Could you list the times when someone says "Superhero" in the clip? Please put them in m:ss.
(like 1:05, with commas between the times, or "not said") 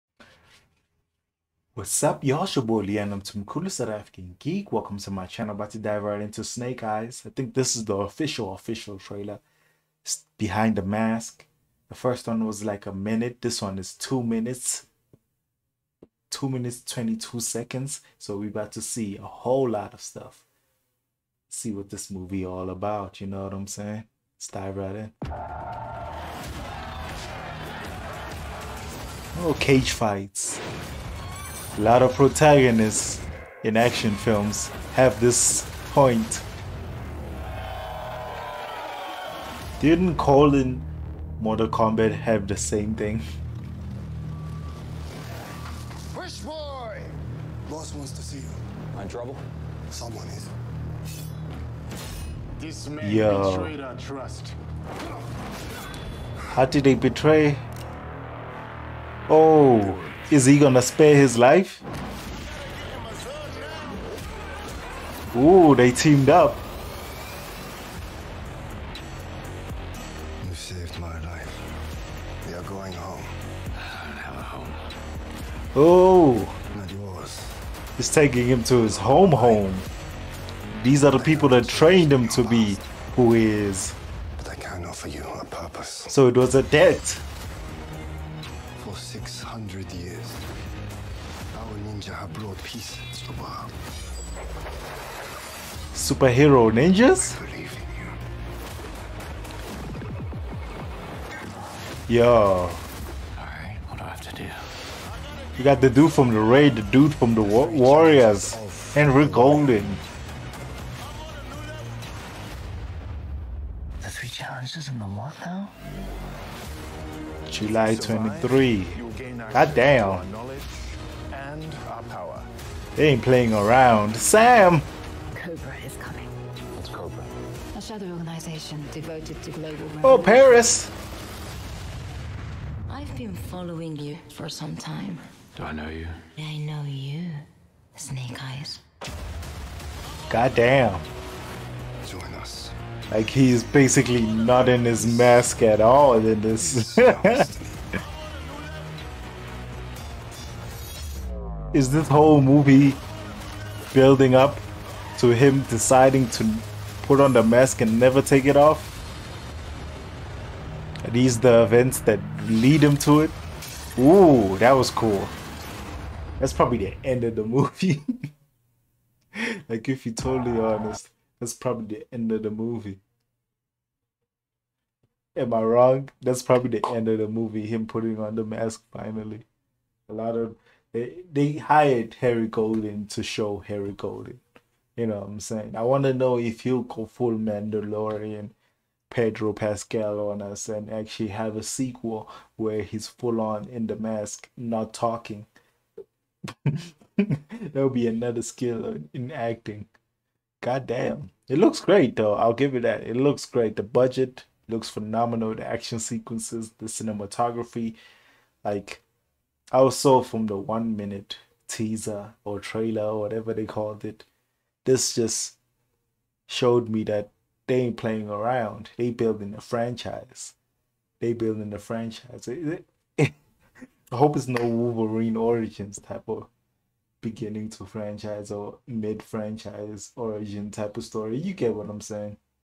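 1:35.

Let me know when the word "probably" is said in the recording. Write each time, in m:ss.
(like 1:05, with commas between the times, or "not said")
2:46, 2:51, 2:56.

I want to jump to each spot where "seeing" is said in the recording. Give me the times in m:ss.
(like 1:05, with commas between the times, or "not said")
not said.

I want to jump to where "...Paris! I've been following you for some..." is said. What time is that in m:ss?
2:10.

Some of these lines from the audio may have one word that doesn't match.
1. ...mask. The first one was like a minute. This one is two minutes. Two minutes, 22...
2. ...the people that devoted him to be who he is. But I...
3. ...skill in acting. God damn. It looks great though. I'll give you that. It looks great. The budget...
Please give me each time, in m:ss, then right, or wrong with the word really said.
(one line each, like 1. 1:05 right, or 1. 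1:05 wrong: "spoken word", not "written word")
1. 0:10 right
2. 1:21 wrong: "trained", not "devoted"
3. 3:18 right.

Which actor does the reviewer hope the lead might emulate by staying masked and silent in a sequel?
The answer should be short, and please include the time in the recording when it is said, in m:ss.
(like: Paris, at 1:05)
Pedro Pascal, at 3:09.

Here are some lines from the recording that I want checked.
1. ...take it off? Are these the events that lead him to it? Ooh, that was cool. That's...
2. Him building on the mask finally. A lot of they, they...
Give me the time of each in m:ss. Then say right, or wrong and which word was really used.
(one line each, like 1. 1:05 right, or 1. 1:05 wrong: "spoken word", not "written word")
1. 2:38 right
2. 2:57 wrong: "putting", not "building".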